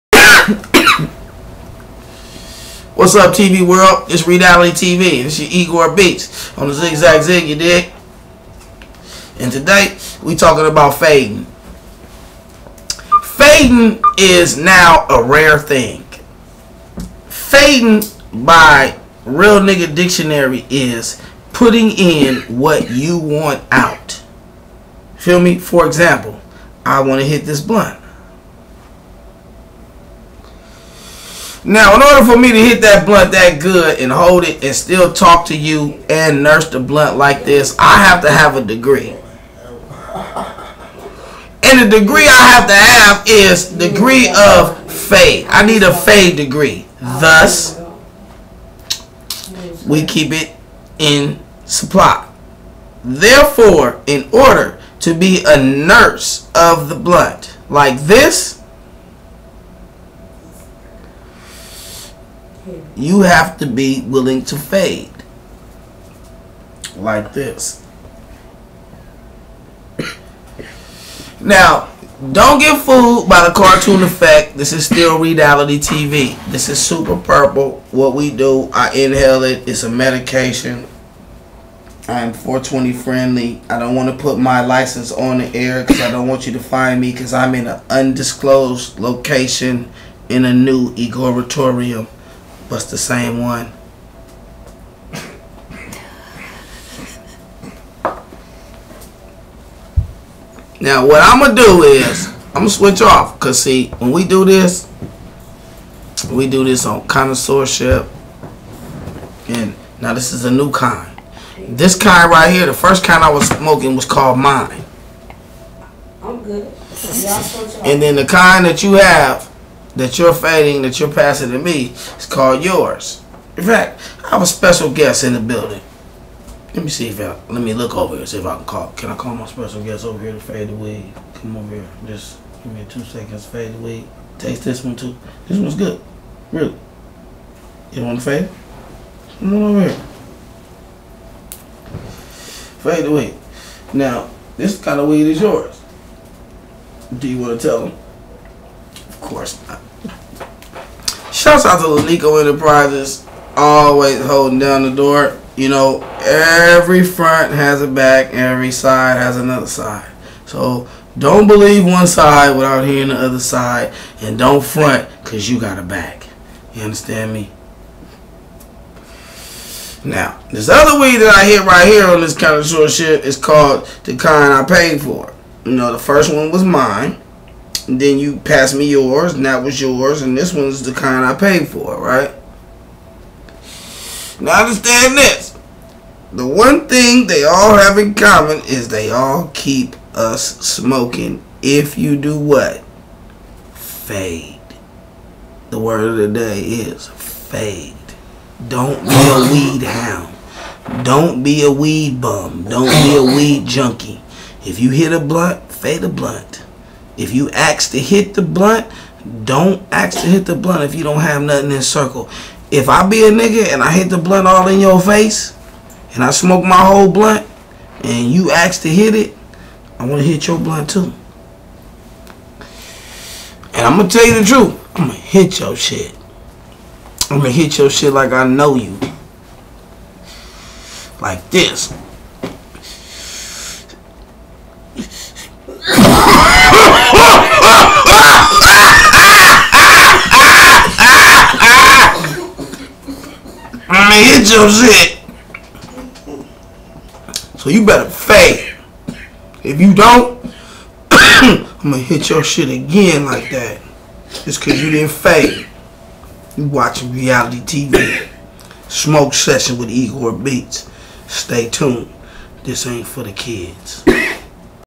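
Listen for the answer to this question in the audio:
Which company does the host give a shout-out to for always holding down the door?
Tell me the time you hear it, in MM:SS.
02:31.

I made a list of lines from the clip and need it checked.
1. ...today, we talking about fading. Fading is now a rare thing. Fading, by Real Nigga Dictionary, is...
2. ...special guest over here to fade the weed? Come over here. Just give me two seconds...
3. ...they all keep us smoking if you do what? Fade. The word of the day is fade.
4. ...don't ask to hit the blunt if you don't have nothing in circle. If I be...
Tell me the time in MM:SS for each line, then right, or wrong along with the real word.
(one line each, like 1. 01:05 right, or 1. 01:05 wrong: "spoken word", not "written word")
1. 00:09 right
2. 02:09 right
3. 03:08 right
4. 03:29 right.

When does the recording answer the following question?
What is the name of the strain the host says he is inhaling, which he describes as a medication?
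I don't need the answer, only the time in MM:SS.
01:16.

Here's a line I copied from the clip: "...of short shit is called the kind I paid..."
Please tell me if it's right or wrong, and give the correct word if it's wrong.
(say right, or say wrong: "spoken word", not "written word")
right.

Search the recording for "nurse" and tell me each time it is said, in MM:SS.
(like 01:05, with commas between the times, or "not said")
00:36, 00:55.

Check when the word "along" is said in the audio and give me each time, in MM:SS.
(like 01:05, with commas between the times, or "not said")
not said.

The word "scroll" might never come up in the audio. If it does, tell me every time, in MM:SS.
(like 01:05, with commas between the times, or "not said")
not said.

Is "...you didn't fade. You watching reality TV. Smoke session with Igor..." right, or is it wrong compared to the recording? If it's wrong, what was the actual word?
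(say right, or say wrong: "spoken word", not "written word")
right.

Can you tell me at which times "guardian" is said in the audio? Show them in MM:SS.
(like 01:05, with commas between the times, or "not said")
not said.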